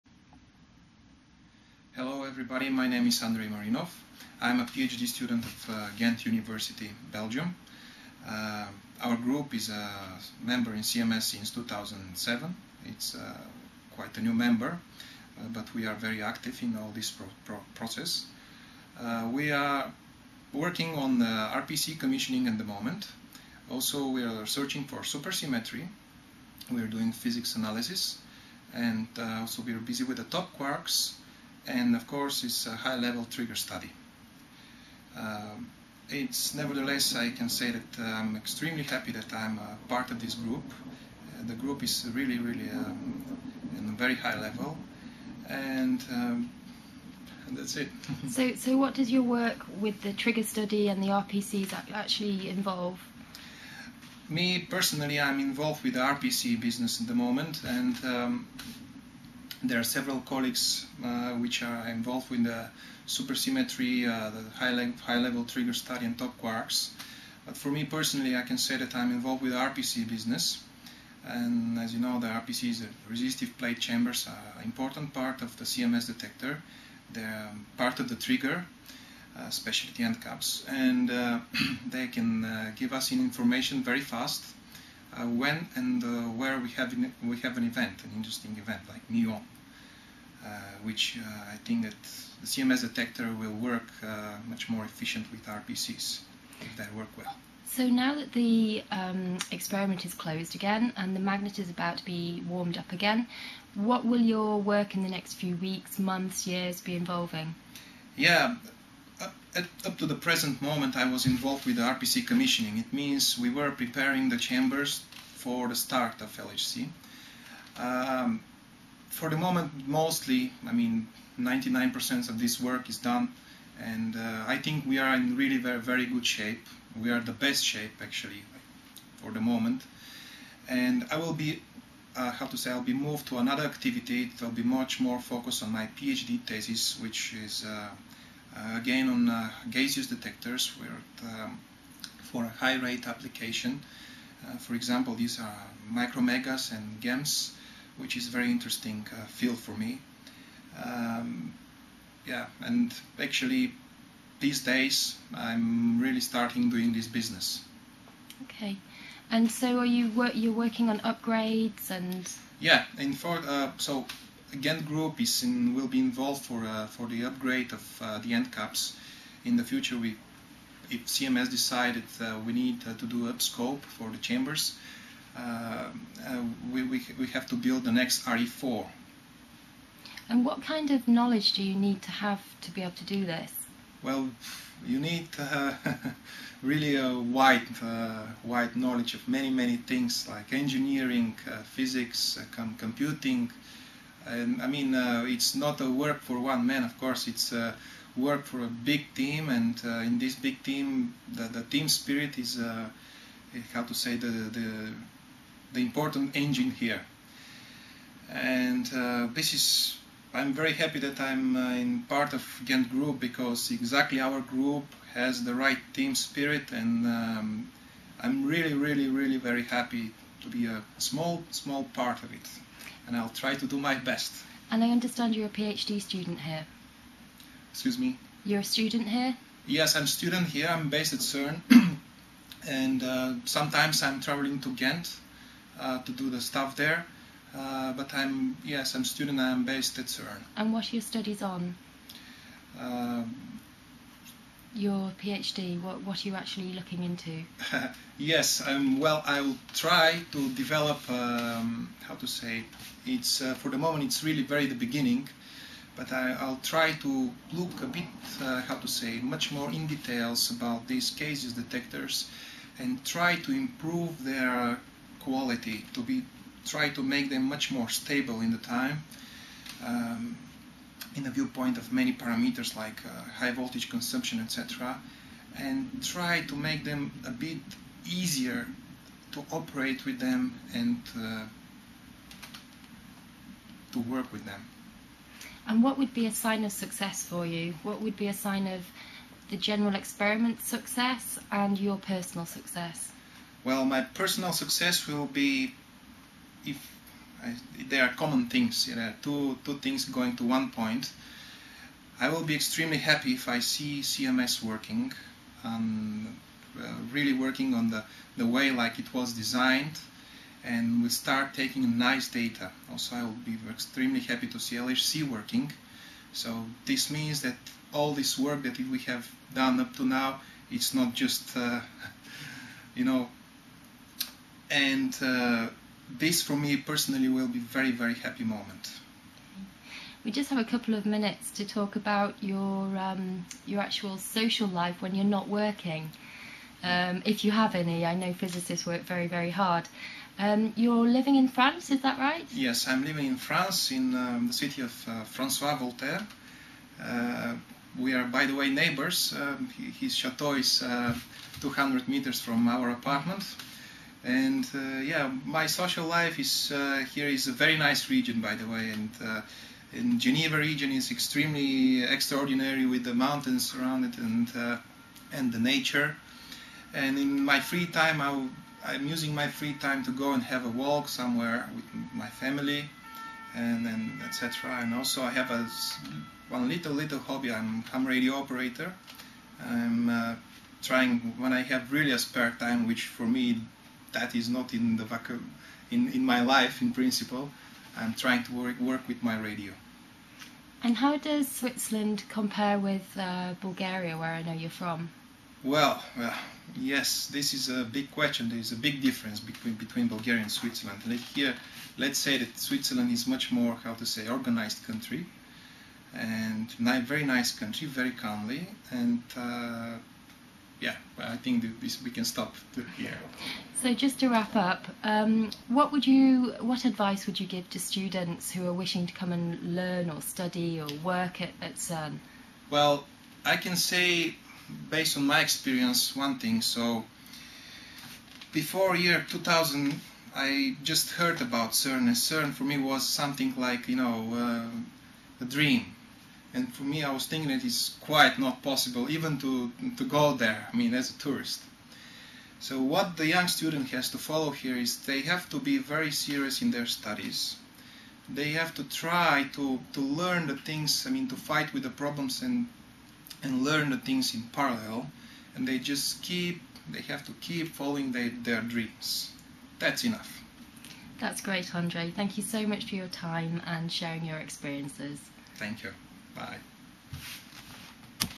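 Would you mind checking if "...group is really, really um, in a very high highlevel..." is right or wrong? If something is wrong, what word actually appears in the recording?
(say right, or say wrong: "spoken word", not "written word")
wrong: "level", not "highlevel".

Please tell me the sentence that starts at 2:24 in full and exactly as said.
Uh, for example, these are micromegas and GEMS which is a very interesting uh, field for me.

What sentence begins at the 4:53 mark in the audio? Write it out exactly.
Well, my personal success will be if I, there are common things.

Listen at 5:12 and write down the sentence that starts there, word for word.
Also, I will be extremely happy to see LHC working.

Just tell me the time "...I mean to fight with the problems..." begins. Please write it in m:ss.
7:31.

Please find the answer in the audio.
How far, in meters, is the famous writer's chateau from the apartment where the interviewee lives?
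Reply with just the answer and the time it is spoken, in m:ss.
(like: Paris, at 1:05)
200 meters, at 5:51.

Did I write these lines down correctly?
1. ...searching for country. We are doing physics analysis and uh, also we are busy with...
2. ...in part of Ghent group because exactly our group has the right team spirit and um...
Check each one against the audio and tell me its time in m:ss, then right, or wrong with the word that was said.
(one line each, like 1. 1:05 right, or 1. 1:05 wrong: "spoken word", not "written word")
1. 0:24 wrong: "supersymmetry", not "country"
2. 3:31 right.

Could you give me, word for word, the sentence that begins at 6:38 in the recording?
There is a big difference between between Bulgaria and Switzerland.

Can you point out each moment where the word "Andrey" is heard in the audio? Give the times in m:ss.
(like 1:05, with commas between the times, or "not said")
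0:03, 7:41.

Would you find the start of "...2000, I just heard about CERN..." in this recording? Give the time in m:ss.
7:09.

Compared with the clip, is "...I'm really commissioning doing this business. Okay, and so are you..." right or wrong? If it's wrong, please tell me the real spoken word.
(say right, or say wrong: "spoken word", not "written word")
wrong: "starting", not "commissioning".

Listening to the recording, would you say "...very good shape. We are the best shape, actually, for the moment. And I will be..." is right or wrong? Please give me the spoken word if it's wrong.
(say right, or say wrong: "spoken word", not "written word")
right.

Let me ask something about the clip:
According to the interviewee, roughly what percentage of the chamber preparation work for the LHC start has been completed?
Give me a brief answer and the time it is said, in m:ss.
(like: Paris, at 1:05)
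99%, at 2:01.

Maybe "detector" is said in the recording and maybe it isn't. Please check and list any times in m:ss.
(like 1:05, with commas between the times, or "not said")
1:16, 1:32, 2:20, 4:21.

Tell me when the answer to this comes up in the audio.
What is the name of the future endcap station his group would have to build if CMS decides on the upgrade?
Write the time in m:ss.
2:58.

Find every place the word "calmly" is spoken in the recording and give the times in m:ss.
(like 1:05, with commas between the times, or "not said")
6:48.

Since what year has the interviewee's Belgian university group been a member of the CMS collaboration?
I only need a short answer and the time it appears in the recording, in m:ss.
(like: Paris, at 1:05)
2007, at 0:11.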